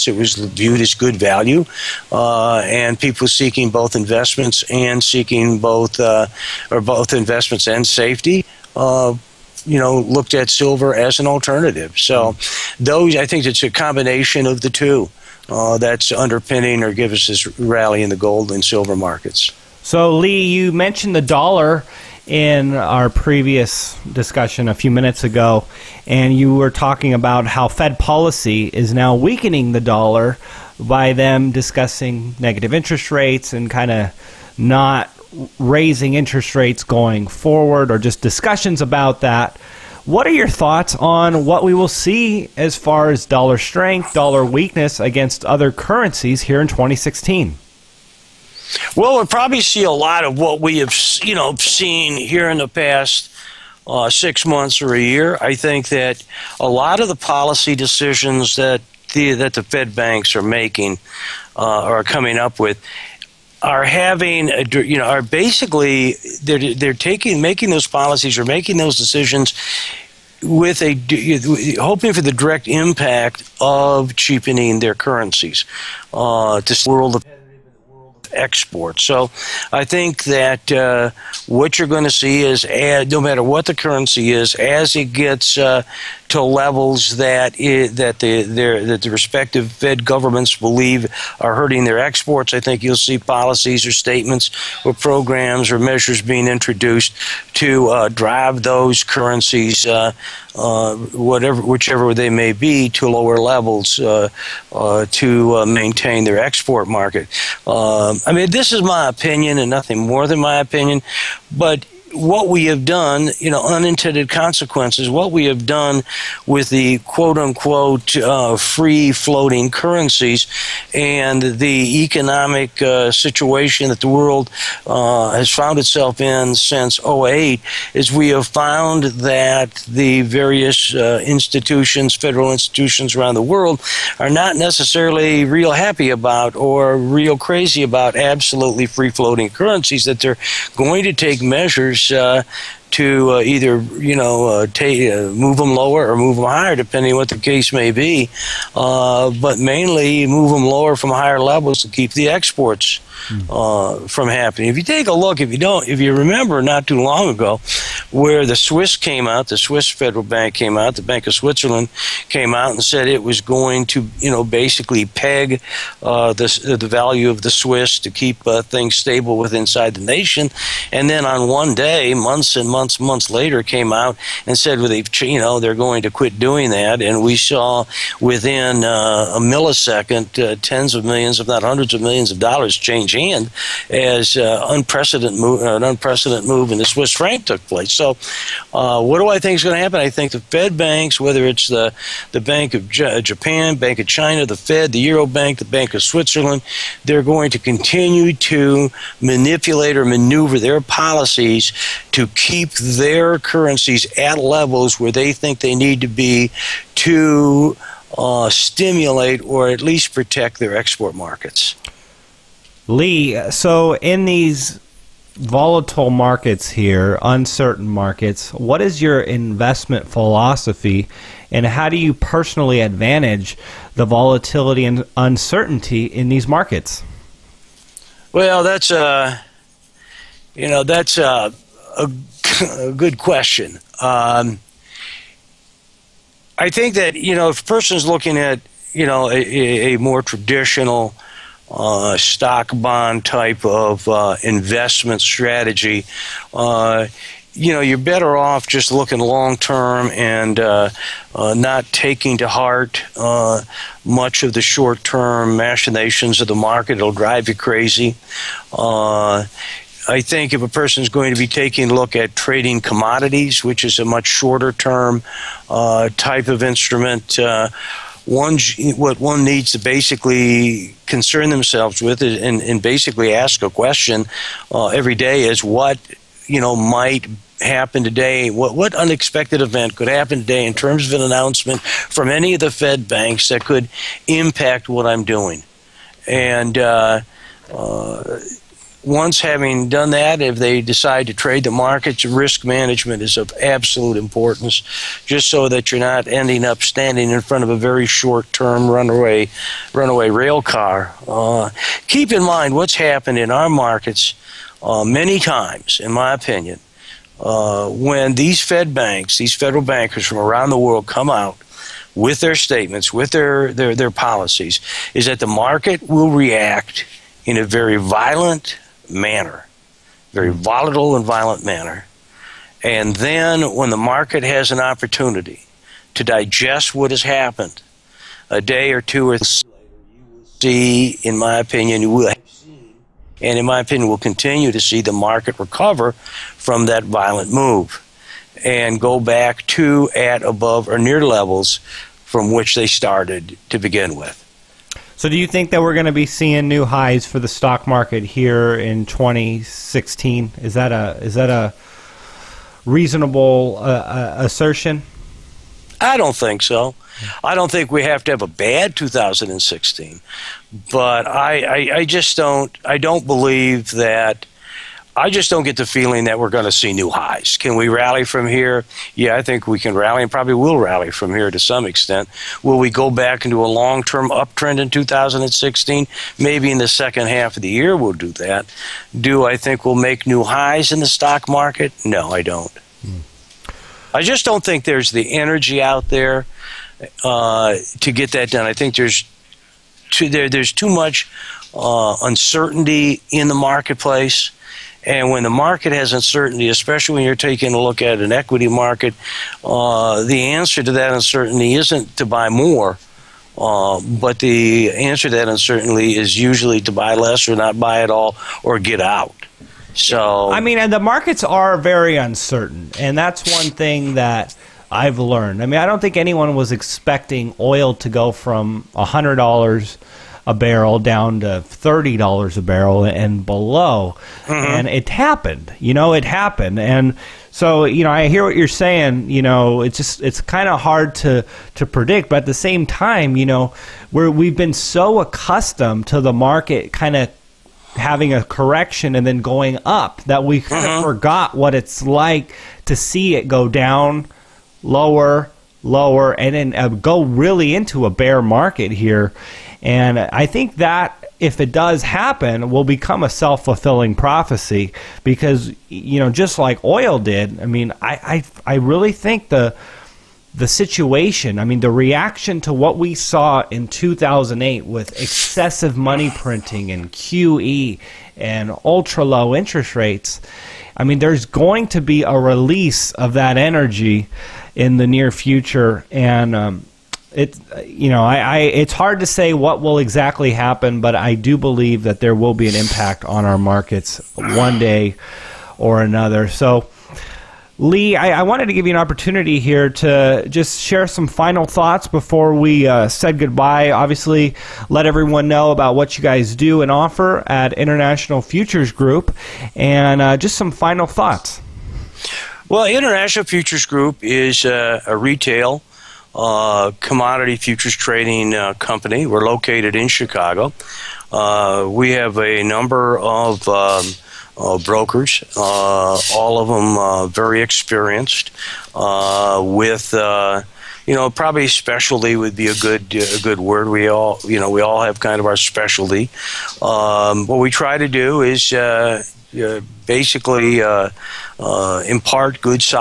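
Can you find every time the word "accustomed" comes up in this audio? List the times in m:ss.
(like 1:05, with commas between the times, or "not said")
7:15.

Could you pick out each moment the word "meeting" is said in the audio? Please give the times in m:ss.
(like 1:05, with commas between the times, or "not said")
not said.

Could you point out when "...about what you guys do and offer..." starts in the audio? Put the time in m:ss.
8:15.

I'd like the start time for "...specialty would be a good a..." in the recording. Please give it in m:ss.
8:41.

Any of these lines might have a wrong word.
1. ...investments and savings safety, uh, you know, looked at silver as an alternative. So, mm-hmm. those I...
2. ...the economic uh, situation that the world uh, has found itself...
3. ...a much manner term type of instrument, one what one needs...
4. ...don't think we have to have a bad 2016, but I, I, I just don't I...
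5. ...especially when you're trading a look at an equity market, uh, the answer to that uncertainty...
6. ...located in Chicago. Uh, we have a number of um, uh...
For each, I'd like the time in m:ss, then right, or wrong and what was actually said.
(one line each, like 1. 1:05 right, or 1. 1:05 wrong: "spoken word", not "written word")
1. 0:07 right
2. 2:01 right
3. 4:23 wrong: "shorter", not "manner"
4. 5:57 right
5. 6:36 wrong: "taking", not "trading"
6. 8:29 right.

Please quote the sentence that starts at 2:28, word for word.
Uh, but mainly move them lower from higher levels to keep the exports uh, from happening.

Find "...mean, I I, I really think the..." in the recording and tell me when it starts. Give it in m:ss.
7:37.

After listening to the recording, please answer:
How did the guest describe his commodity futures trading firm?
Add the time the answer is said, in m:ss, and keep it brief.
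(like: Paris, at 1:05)
retail, at 8:25.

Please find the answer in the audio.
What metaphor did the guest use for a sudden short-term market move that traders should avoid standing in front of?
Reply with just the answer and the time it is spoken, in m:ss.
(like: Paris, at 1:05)
runaway rail car, at 4:59.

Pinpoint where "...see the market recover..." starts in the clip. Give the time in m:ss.
5:34.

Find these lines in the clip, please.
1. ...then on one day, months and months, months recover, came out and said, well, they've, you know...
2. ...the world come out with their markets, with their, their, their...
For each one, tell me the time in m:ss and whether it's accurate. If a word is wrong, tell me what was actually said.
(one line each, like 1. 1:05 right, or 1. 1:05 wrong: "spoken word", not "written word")
1. 2:51 wrong: "later", not "recover"
2. 5:10 wrong: "statements", not "markets".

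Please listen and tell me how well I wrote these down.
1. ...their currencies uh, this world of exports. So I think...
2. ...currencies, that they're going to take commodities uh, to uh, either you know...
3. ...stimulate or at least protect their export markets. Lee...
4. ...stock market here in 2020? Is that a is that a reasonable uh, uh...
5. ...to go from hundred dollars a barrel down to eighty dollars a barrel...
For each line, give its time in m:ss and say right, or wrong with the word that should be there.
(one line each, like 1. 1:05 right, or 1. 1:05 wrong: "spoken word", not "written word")
1. 1:14 right
2. 2:19 wrong: "measures", not "commodities"
3. 3:28 right
4. 5:47 wrong: "2016", not "2020"
5. 6:57 wrong: "thirty", not "eighty".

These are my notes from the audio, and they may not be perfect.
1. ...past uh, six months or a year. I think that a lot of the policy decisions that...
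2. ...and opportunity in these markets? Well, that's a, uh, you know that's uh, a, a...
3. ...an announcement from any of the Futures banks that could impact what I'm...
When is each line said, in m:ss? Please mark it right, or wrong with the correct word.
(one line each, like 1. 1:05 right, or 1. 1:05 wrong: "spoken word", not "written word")
1. 0:52 right
2. 3:44 wrong: "uncertainty", not "opportunity"
3. 4:41 wrong: "Fed", not "Futures".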